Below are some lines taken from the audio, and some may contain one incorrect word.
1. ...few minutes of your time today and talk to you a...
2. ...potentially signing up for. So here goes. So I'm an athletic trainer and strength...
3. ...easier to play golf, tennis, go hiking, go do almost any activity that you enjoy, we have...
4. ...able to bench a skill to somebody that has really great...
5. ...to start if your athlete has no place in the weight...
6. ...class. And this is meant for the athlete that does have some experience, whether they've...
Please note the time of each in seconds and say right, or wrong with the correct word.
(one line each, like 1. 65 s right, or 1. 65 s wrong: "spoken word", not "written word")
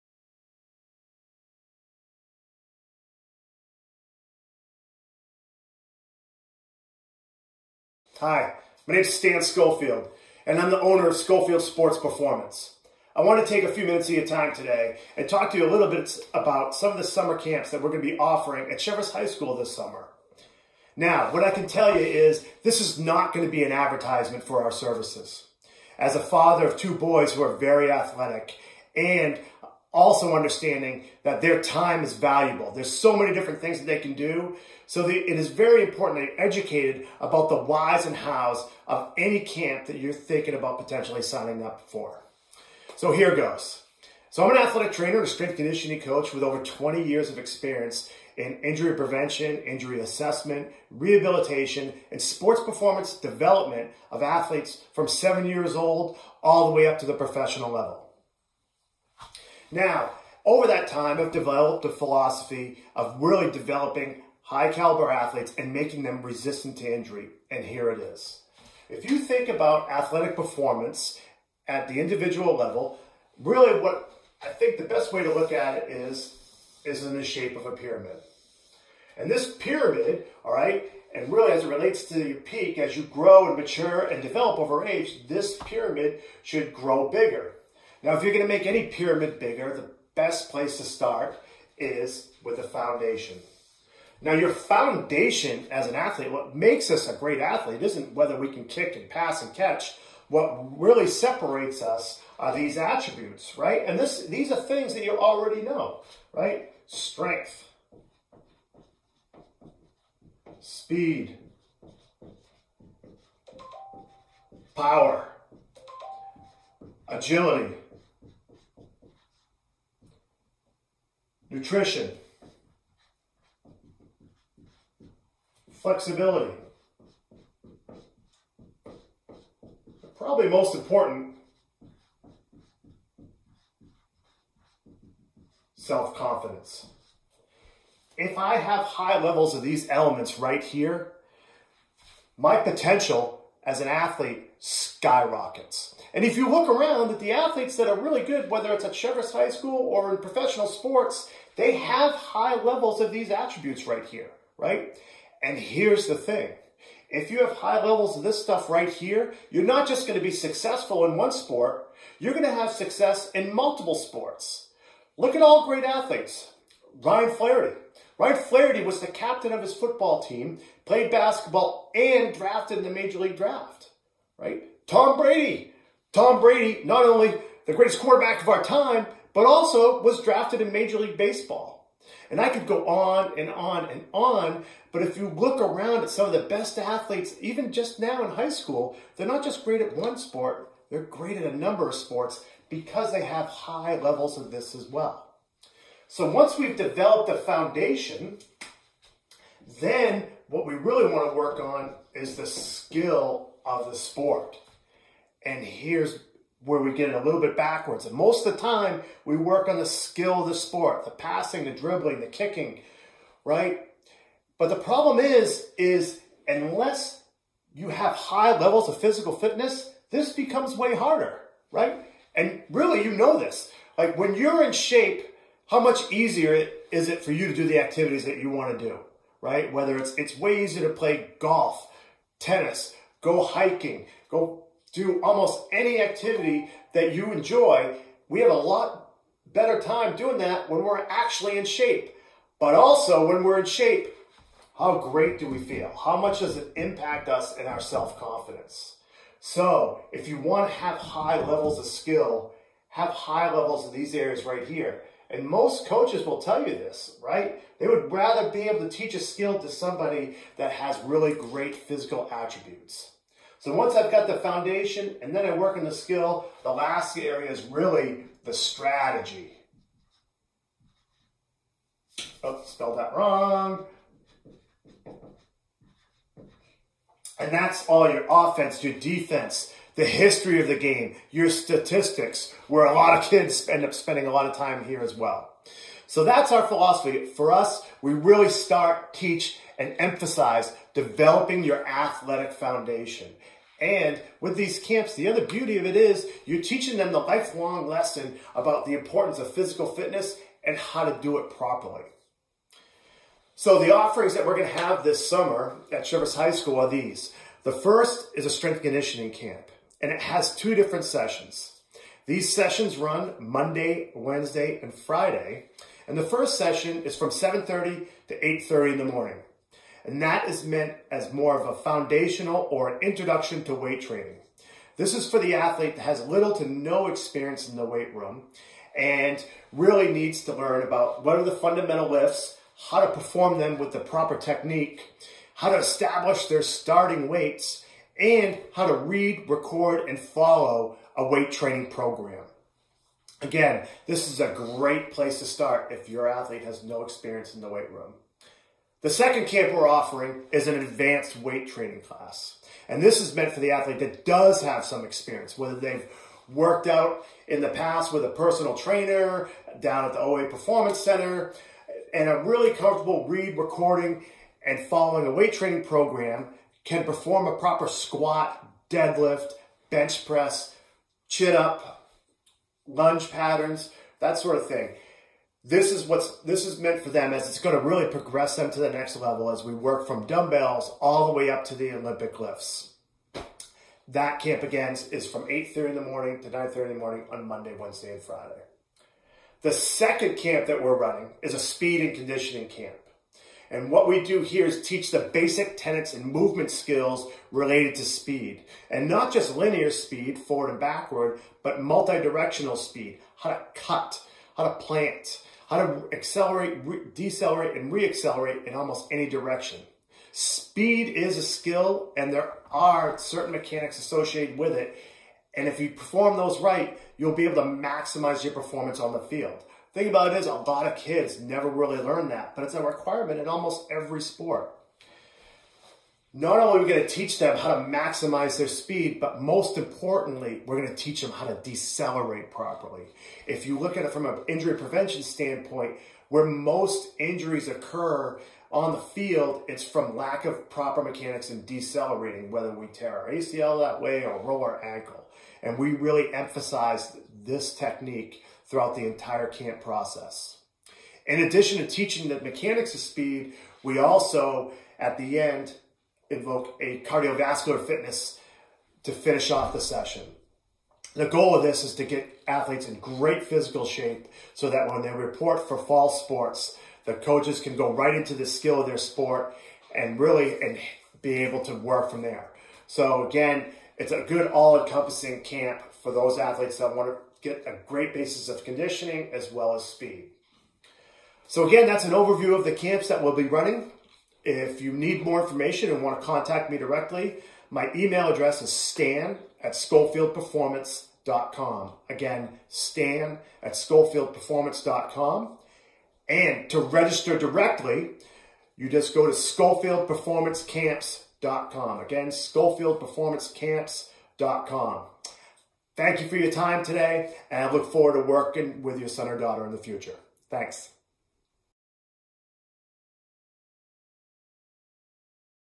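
1. 13 s right
2. 40 s right
3. 230 s right
4. 258 s wrong: "teach", not "bench"
5. 345 s wrong: "experience", not "place"
6. 352 s right.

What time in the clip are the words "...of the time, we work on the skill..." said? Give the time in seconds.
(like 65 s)
208 s.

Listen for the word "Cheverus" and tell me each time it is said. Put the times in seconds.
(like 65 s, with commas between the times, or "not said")
18 s, 148 s, 306 s.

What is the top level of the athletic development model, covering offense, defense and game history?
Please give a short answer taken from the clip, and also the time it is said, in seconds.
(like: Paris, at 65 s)
Strategy, at 268 s.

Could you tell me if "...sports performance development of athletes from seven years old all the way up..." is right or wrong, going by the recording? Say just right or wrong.
right.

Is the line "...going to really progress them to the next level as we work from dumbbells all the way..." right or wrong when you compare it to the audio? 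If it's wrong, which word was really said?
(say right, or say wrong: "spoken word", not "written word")
right.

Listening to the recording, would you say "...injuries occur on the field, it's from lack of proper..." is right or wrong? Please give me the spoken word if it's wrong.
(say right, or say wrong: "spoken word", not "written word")
right.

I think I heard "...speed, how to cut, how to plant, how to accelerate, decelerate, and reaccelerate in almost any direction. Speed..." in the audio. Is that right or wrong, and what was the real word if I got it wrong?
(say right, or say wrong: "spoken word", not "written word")
right.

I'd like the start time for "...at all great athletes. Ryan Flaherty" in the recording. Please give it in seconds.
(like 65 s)
165 s.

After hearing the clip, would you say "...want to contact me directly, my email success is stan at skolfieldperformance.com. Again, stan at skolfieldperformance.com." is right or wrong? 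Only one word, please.
wrong.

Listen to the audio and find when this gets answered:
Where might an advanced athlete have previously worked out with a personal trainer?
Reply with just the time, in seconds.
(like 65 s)
360 s.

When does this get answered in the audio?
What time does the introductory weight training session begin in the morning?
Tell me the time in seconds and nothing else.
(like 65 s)
317 s.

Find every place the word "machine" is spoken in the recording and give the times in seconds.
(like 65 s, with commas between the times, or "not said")
not said.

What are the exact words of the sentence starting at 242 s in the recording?
But also when we're in shape, how great do we feel?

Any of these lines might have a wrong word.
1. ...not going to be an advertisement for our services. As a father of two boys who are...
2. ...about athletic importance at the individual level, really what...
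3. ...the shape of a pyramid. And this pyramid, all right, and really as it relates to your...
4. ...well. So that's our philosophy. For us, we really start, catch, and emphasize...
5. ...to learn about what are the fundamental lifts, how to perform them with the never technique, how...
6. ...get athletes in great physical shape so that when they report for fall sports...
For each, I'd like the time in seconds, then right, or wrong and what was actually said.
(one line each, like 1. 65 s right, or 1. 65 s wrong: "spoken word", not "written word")
1. 22 s right
2. 69 s wrong: "performance", not "importance"
3. 77 s right
4. 285 s wrong: "teach", not "catch"
5. 330 s wrong: "proper", not "never"
6. 462 s right.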